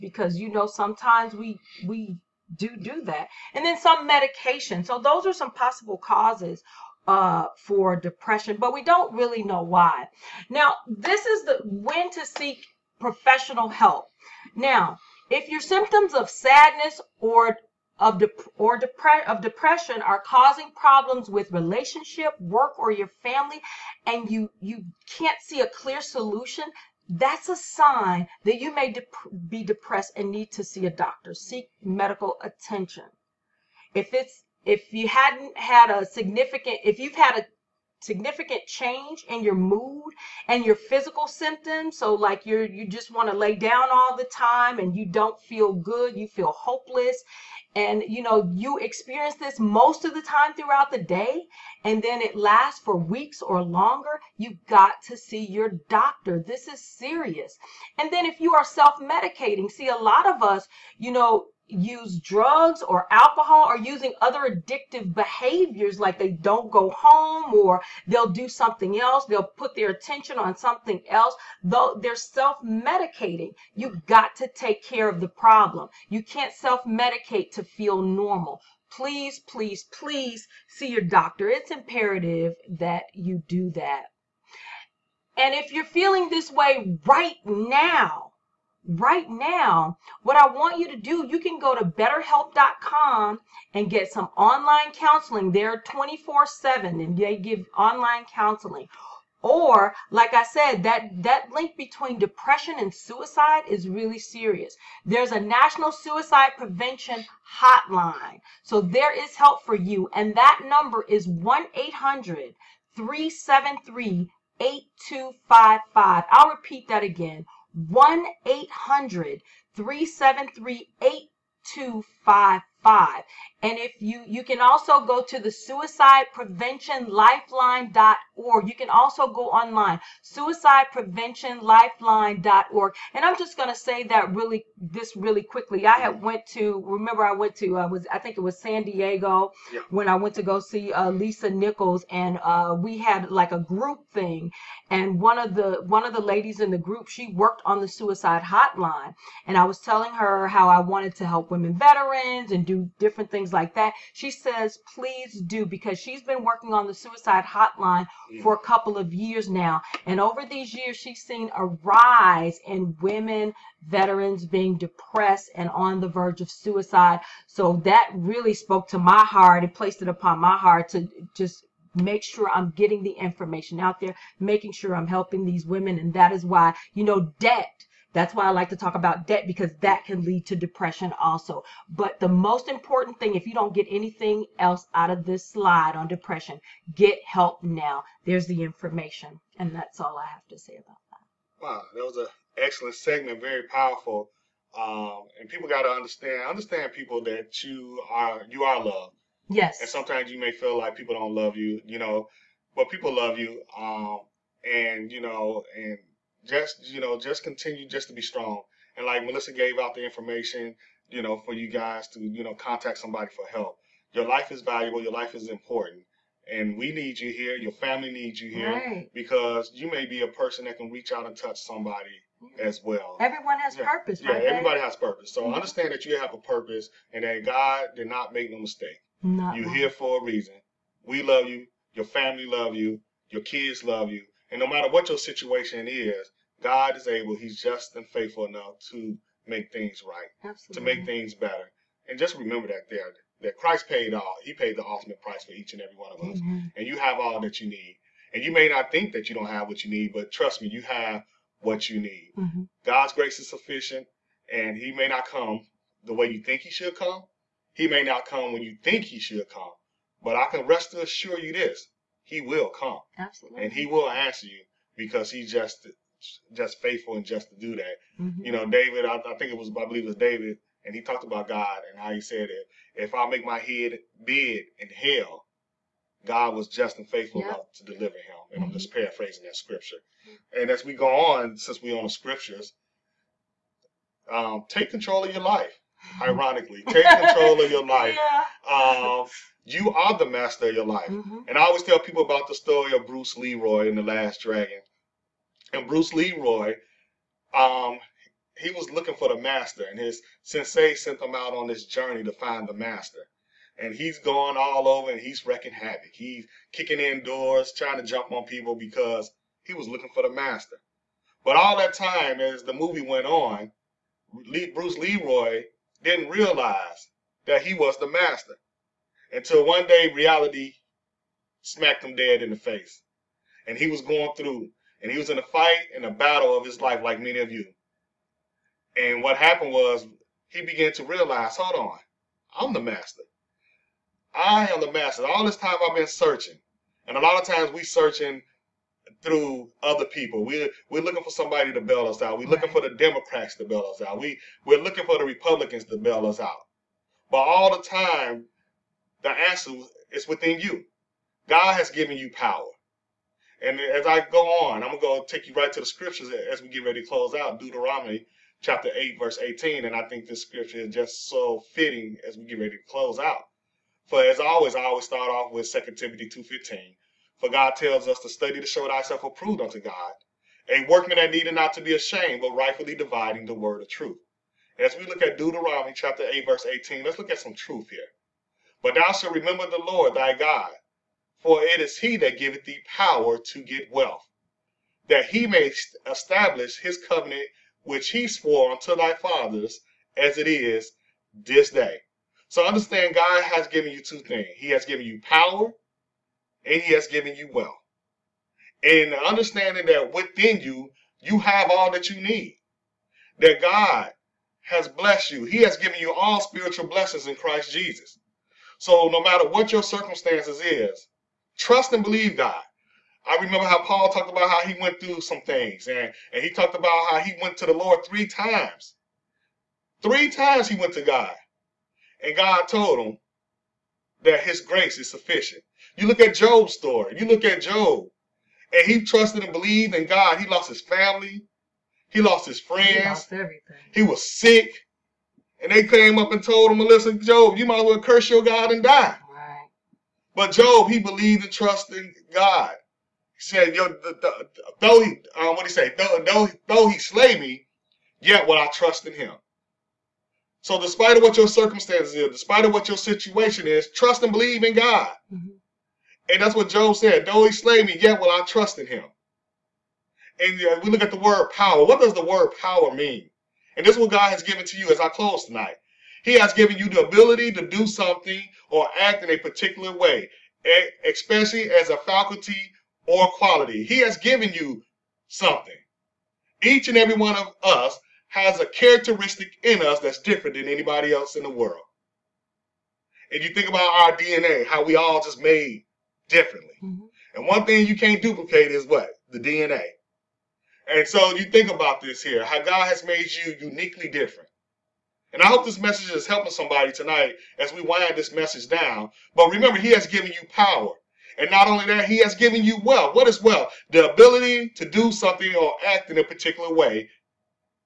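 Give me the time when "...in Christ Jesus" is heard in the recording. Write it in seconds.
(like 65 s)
407 s.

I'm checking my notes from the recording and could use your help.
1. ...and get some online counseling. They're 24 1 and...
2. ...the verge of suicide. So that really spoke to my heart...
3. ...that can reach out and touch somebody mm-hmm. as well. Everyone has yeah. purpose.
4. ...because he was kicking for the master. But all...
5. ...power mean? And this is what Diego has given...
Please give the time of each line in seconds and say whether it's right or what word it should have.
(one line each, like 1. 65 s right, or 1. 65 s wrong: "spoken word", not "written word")
1. 93 s wrong: "7", not "1"
2. 165 s right
3. 220 s right
4. 308 s wrong: "looking", not "kicking"
5. 462 s wrong: "God", not "Diego".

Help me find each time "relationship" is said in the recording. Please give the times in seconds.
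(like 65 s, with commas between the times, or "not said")
21 s.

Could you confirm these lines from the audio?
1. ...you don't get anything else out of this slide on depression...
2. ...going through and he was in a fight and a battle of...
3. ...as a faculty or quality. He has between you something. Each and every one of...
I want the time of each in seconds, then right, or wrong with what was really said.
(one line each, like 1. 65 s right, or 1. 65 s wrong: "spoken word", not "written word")
1. 183 s right
2. 324 s right
3. 471 s wrong: "given", not "between".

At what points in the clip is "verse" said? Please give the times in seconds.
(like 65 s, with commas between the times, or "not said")
359 s, 376 s.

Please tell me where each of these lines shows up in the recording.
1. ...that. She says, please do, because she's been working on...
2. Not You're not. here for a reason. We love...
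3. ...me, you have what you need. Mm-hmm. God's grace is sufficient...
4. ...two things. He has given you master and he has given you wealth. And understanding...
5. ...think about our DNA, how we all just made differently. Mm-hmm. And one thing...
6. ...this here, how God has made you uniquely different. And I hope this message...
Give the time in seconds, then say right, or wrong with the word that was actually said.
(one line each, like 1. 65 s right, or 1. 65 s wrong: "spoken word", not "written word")
1. 153 s right
2. 229 s right
3. 250 s right
4. 394 s wrong: "power", not "master"
5. 483 s right
6. 491 s right.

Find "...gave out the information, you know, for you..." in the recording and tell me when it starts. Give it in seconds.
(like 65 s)
209 s.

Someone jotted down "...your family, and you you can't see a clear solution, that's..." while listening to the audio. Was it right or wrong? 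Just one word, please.
right.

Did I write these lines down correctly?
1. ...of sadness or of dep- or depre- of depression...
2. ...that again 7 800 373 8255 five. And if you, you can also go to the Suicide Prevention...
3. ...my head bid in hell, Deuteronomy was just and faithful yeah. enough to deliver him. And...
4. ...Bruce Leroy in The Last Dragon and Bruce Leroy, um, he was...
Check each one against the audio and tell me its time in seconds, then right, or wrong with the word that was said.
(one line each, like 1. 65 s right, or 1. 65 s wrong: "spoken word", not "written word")
1. 16 s right
2. 116 s wrong: "1", not "7"
3. 273 s wrong: "God", not "Deuteronomy"
4. 293 s right.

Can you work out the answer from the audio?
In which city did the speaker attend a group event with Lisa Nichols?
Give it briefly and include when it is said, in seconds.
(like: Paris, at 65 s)
San Diego, at 138 s.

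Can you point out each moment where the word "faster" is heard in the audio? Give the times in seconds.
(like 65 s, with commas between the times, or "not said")
not said.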